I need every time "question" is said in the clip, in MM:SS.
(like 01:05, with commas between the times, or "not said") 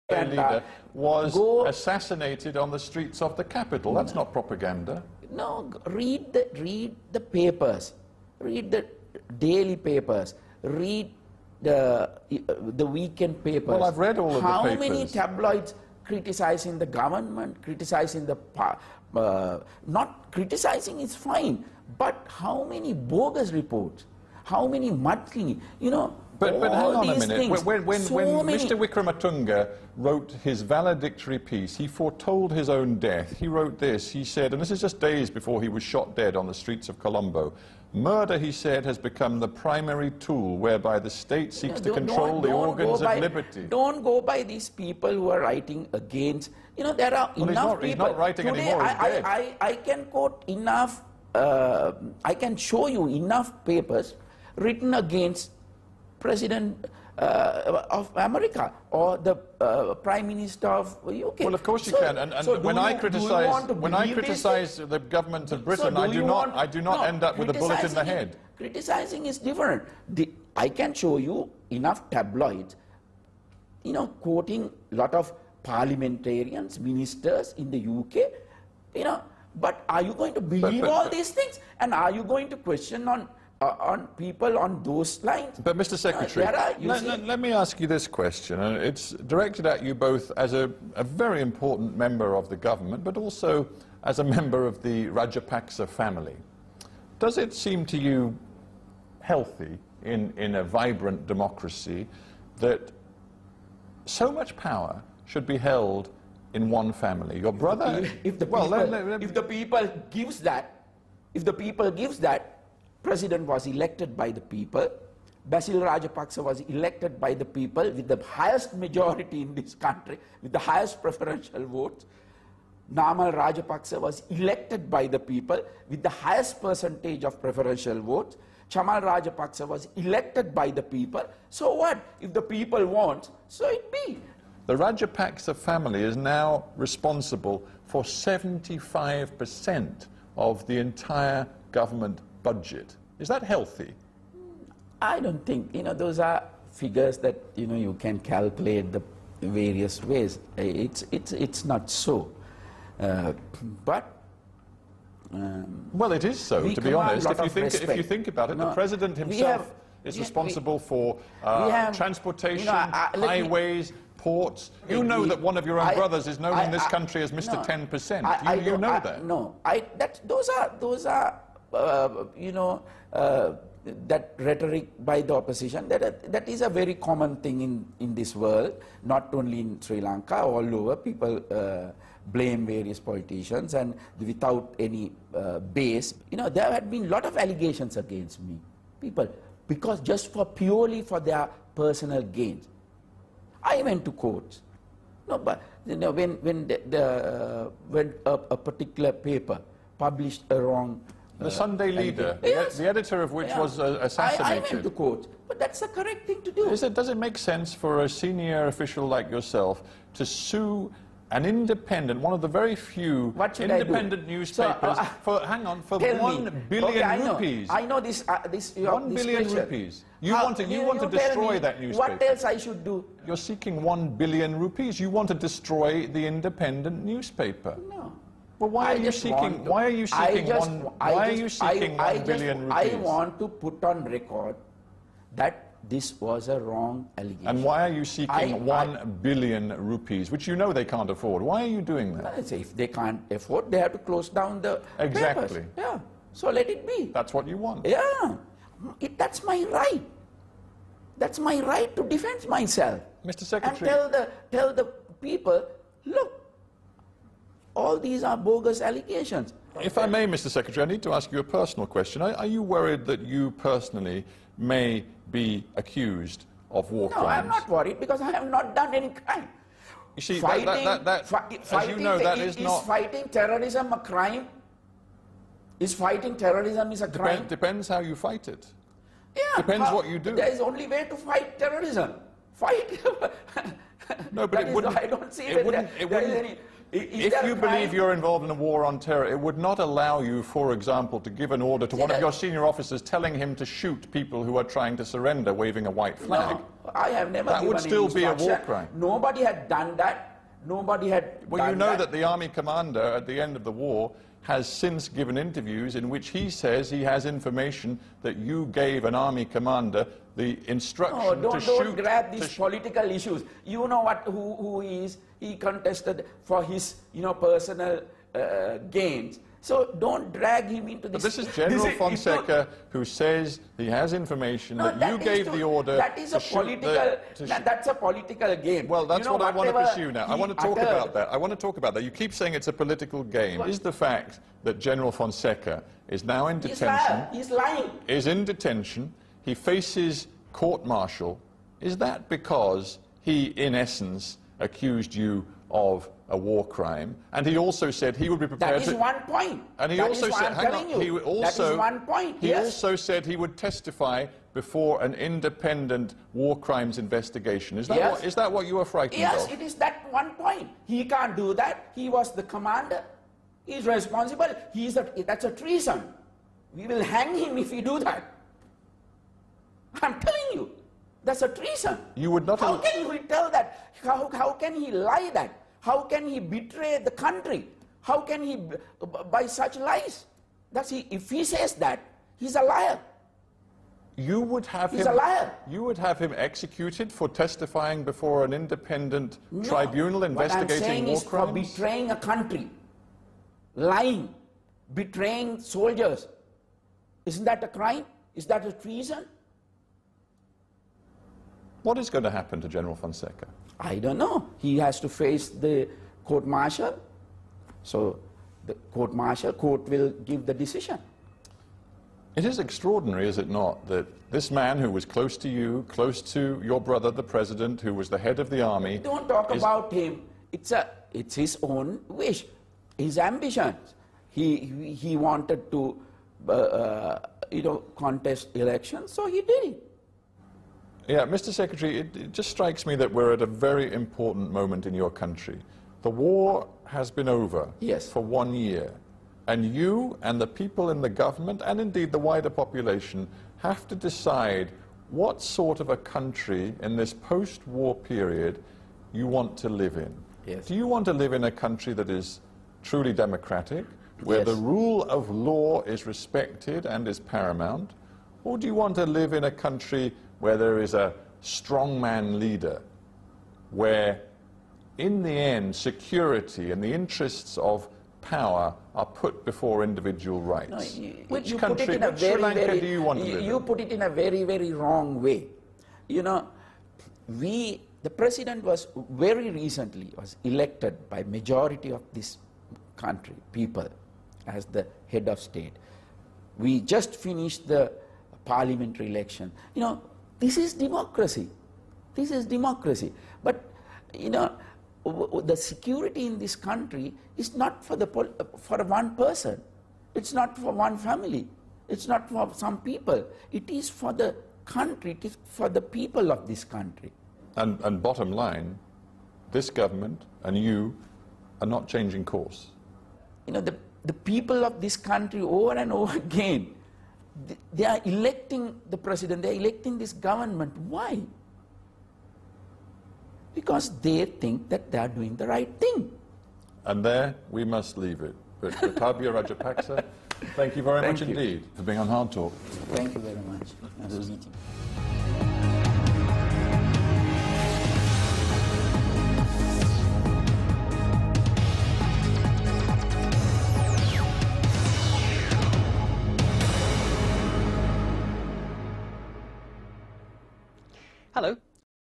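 01:22, 01:28, 04:21.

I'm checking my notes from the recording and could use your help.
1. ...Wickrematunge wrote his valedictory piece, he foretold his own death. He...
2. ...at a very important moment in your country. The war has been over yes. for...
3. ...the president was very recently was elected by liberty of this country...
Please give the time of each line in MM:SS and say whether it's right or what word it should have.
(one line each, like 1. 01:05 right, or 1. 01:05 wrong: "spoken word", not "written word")
1. 00:28 right
2. 07:13 right
3. 07:58 wrong: "majority", not "liberty".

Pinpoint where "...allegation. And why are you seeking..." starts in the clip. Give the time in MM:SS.
03:57.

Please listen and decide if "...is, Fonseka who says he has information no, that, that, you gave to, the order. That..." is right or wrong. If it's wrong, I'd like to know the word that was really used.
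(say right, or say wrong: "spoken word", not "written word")
right.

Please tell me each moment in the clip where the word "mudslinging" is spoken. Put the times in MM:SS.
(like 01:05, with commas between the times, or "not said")
00:24.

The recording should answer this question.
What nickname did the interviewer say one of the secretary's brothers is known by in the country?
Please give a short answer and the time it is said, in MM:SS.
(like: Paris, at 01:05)
Mr. 10%, at 02:47.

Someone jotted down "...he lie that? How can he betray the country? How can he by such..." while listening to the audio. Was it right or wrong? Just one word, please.
right.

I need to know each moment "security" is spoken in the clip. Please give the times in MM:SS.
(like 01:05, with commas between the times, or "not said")
07:45, 08:15.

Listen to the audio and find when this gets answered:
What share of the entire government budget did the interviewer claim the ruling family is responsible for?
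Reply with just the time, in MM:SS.
02:18.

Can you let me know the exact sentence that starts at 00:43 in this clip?
Don't go by these people who are writing against.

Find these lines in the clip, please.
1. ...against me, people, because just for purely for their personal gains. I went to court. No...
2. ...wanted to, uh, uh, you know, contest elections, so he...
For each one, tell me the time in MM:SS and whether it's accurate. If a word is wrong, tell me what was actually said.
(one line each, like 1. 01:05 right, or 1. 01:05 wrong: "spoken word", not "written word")
1. 03:07 right
2. 07:05 right.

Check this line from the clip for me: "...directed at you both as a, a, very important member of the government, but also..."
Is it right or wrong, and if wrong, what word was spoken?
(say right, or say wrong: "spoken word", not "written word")
right.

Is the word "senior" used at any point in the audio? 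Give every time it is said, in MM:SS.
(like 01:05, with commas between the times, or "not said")
03:28, 04:52.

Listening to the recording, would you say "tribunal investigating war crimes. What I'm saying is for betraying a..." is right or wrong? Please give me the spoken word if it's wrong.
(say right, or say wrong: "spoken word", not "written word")
right.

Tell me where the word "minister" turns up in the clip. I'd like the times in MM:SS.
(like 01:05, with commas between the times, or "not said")
01:00, 01:16.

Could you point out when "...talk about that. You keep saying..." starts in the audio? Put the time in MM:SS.
05:31.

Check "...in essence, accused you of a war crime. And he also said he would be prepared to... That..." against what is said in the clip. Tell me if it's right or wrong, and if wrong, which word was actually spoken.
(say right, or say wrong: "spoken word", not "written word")
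right.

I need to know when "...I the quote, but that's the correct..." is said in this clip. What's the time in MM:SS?
03:24.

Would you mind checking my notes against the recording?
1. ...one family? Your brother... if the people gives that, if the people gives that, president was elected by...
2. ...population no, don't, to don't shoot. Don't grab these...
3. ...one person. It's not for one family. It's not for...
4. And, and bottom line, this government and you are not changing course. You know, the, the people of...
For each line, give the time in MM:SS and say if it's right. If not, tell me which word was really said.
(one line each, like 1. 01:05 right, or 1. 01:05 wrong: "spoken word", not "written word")
1. 01:46 right
2. 05:10 wrong: "instruction", not "population"
3. 08:18 right
4. 08:27 right.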